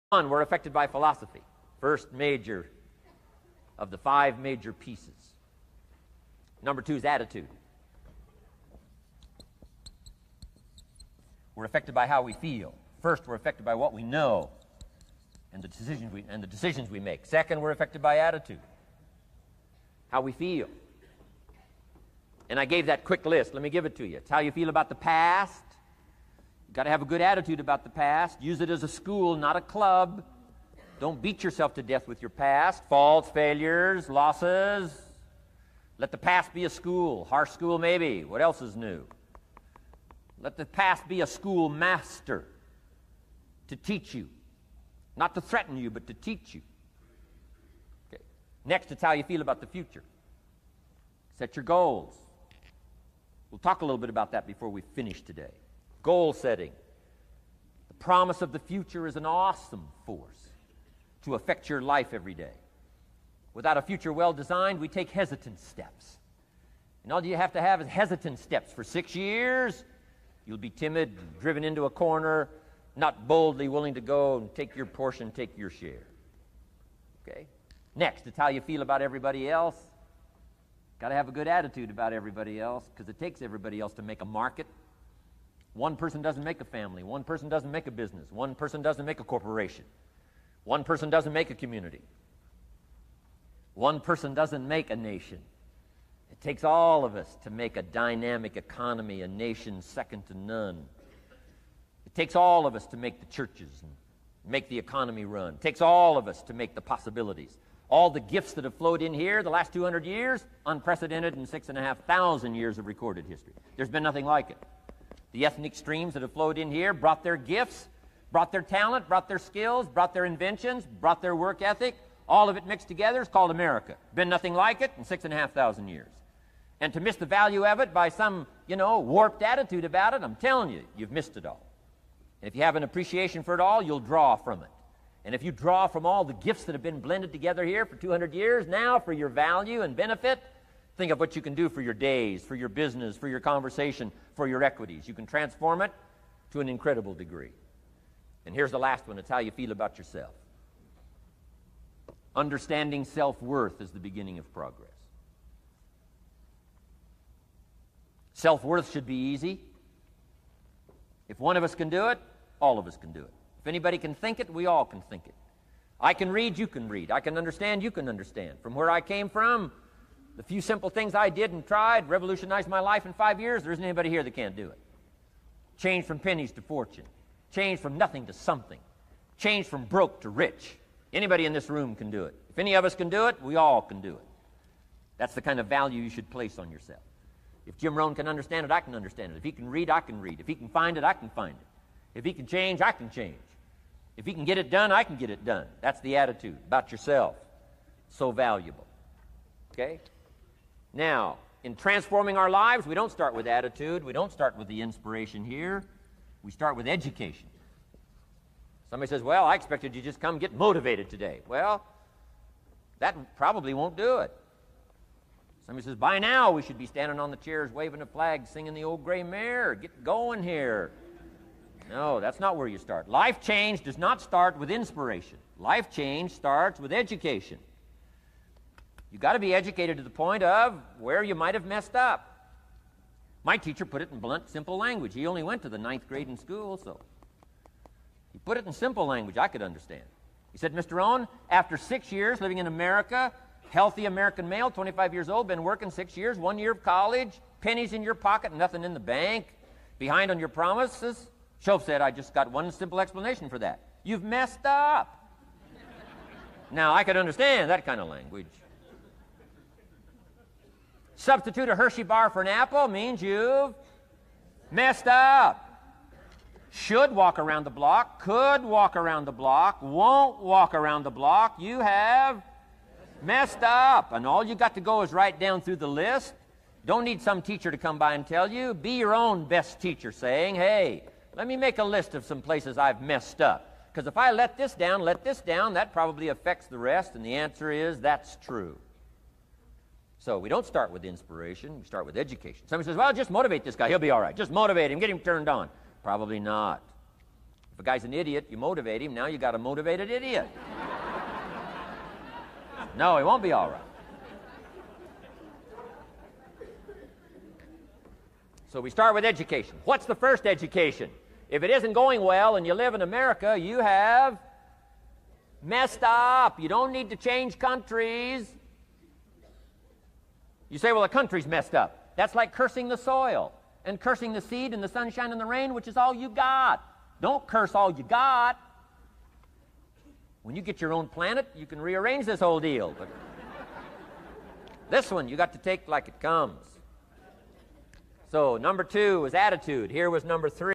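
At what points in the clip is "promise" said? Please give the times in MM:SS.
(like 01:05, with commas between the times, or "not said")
00:57, 04:10.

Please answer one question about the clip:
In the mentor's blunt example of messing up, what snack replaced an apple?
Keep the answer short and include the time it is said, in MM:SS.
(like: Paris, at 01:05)
A Hershey bar, at 04:21.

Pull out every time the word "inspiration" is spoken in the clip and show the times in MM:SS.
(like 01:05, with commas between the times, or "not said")
03:24, 03:44, 04:51.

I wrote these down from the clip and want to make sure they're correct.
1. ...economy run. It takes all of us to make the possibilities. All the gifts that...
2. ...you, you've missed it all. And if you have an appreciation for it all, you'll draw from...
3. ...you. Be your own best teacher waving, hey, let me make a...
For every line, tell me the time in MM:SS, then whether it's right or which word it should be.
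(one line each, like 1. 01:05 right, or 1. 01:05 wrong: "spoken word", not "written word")
1. 01:44 right
2. 02:10 right
3. 04:38 wrong: "saying", not "waving".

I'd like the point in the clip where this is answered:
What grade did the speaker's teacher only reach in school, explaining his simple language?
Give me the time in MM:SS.
03:55.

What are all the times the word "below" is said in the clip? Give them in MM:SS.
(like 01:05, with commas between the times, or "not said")
not said.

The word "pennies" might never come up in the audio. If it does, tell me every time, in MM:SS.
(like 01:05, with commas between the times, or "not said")
02:56, 04:07.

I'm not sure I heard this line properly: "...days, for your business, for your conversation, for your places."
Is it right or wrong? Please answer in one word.
wrong.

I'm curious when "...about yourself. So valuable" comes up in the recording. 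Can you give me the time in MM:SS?
03:16.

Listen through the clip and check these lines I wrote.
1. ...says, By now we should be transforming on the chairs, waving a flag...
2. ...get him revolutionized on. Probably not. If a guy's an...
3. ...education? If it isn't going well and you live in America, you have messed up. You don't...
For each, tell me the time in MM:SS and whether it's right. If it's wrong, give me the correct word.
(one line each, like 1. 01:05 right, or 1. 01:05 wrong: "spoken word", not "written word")
1. 03:35 wrong: "standing", not "transforming"
2. 04:54 wrong: "turned", not "revolutionized"
3. 05:10 right.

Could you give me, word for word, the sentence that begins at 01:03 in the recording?
Without a future well designed, we take hesitant steps.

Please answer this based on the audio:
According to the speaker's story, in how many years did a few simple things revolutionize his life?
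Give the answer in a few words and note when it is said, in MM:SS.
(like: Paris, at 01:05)
5 years, at 02:53.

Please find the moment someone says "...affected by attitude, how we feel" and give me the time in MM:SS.
00:17.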